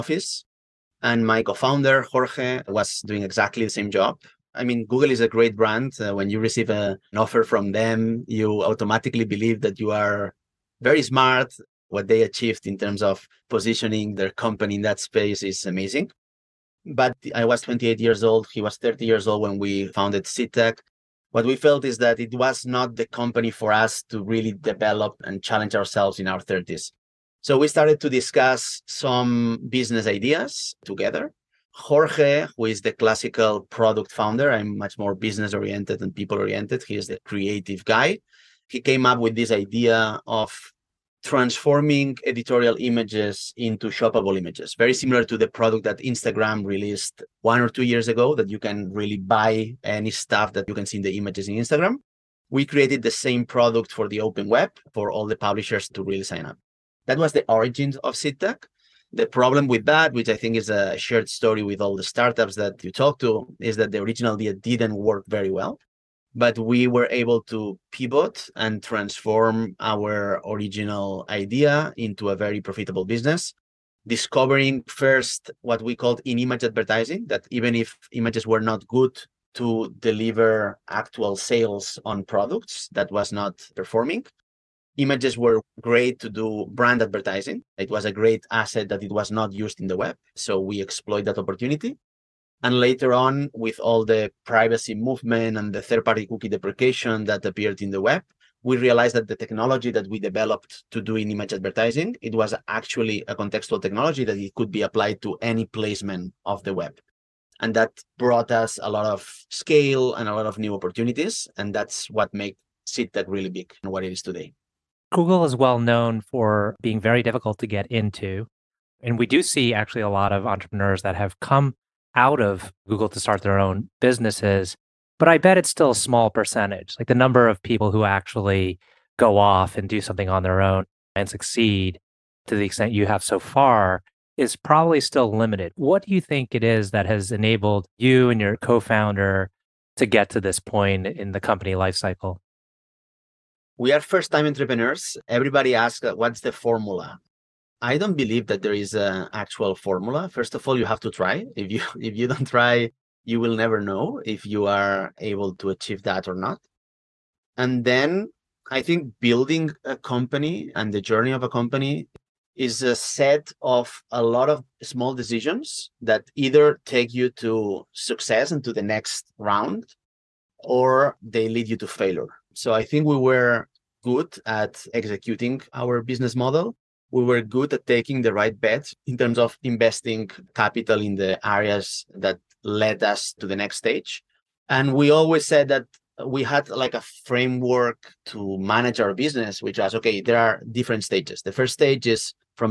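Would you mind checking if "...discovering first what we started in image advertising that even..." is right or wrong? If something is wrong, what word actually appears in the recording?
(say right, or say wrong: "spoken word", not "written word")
wrong: "called", not "started".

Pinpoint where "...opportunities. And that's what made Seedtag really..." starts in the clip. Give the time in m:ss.
1:50.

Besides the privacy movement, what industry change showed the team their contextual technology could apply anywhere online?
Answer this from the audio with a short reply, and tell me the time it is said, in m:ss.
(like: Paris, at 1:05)
third party cookie deprecation, at 1:35.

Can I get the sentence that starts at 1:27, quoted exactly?
It was a great asset that it was not used in the web.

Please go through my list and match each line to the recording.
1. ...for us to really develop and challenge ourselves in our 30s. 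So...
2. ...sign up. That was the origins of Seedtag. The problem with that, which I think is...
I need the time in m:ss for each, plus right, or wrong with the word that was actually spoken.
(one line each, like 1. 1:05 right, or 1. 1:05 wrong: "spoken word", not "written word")
1. 0:23 right
2. 0:56 right.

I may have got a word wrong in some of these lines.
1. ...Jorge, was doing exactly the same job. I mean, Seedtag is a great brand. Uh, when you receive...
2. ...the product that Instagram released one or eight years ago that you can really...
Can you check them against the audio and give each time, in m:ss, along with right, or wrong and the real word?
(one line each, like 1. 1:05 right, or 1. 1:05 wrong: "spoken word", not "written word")
1. 0:02 wrong: "Google", not "Seedtag"
2. 0:45 wrong: "two", not "eight".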